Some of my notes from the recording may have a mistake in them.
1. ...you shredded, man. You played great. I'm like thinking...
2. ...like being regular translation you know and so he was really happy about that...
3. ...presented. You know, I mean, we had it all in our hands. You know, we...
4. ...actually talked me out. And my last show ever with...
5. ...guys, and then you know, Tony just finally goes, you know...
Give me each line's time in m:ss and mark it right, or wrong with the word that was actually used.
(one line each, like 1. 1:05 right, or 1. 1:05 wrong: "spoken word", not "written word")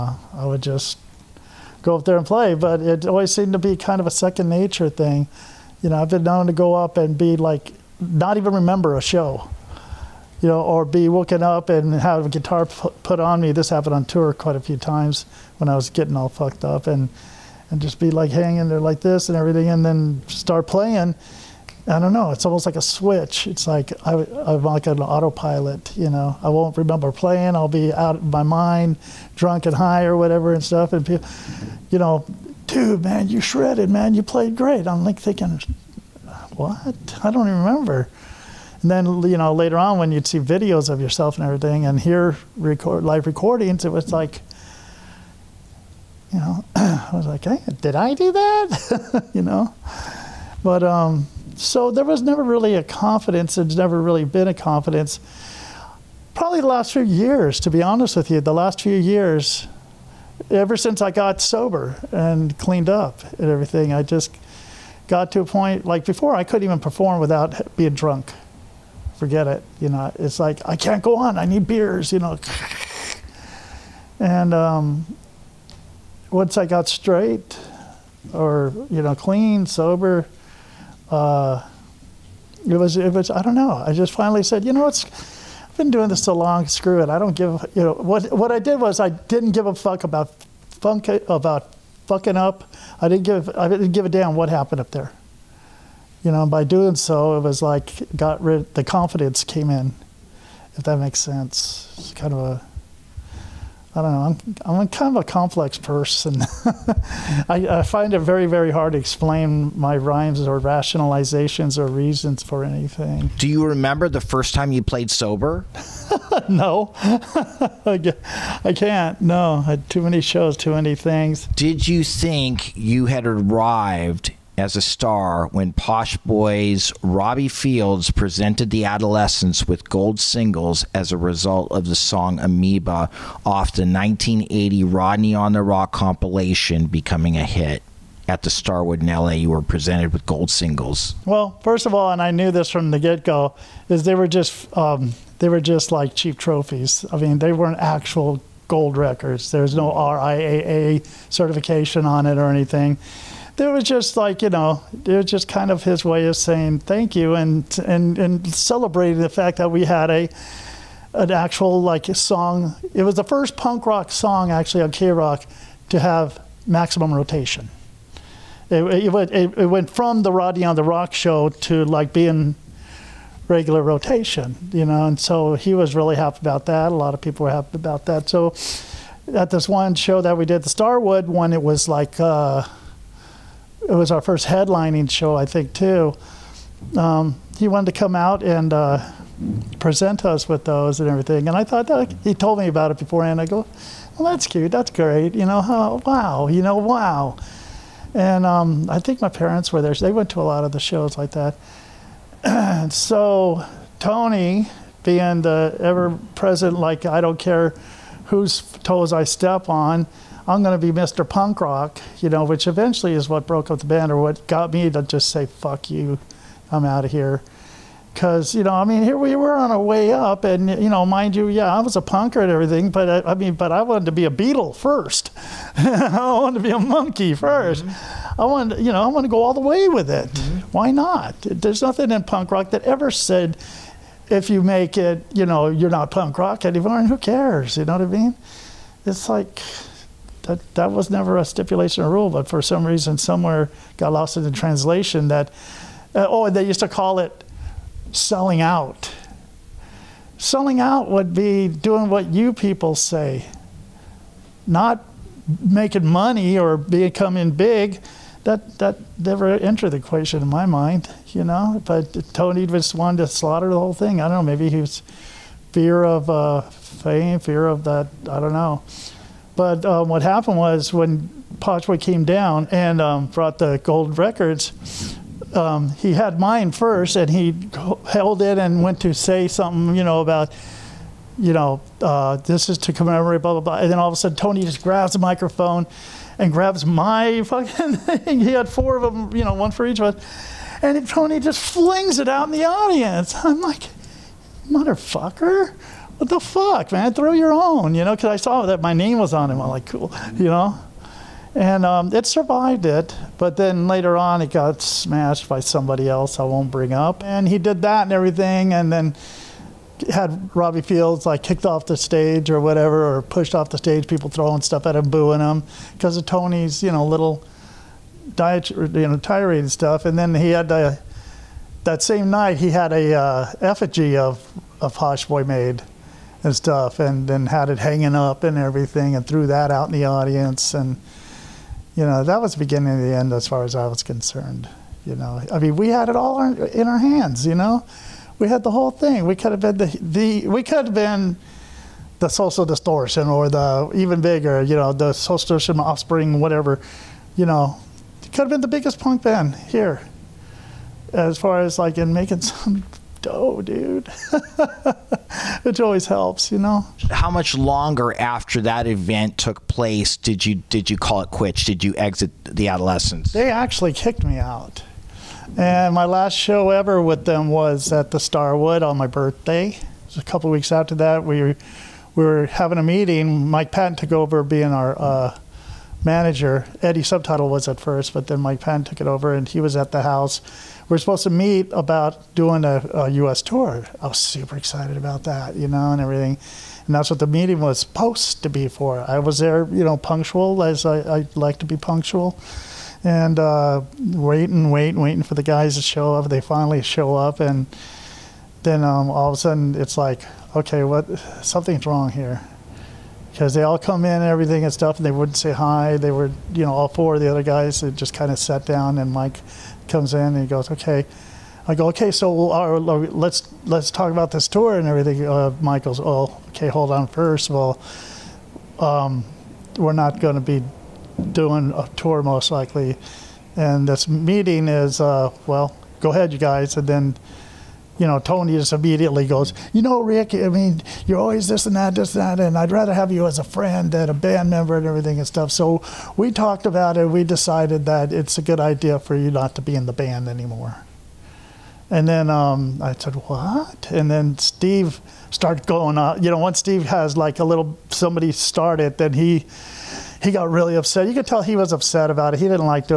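1. 0:33 right
2. 2:51 wrong: "rotation", not "translation"
3. 5:34 wrong: "concerned", not "presented"
4. 6:03 wrong: "kicked", not "talked"
5. 7:06 wrong: "immediately", not "finally".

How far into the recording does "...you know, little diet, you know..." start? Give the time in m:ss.
5:16.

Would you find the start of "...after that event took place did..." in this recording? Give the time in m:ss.
5:58.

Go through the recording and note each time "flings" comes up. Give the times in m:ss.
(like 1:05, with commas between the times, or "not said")
4:51.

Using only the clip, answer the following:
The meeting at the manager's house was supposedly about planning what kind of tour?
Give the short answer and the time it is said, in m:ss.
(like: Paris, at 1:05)
U.S. tour, at 6:23.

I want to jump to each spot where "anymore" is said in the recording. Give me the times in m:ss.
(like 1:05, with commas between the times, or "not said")
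3:56, 7:20.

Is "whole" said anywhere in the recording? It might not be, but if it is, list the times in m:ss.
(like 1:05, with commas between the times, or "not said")
4:23, 5:38.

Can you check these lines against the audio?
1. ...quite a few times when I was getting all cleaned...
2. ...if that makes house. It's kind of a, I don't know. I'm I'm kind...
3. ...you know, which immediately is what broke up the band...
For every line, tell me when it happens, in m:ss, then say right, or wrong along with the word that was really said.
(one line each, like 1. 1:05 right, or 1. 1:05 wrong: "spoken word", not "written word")
1. 0:14 wrong: "fucked", not "cleaned"
2. 1:40 wrong: "sense", not "house"
3. 3:32 wrong: "eventually", not "immediately".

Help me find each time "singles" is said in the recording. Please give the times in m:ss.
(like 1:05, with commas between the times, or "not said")
2:10, 2:20.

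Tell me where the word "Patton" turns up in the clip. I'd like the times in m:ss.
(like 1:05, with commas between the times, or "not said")
6:13, 6:18.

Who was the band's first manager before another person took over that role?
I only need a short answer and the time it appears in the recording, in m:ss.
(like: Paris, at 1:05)
Eddie Subtitle, at 6:16.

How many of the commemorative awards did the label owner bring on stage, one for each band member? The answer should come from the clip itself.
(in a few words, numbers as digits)
4.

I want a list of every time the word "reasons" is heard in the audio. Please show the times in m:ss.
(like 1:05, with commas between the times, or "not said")
1:51, 4:02.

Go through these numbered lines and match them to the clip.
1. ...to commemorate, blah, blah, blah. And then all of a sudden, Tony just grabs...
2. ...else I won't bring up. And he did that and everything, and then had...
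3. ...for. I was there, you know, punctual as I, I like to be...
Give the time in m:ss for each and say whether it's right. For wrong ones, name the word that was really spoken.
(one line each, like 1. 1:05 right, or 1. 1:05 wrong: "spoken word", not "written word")
1. 4:42 right
2. 5:06 right
3. 6:28 right.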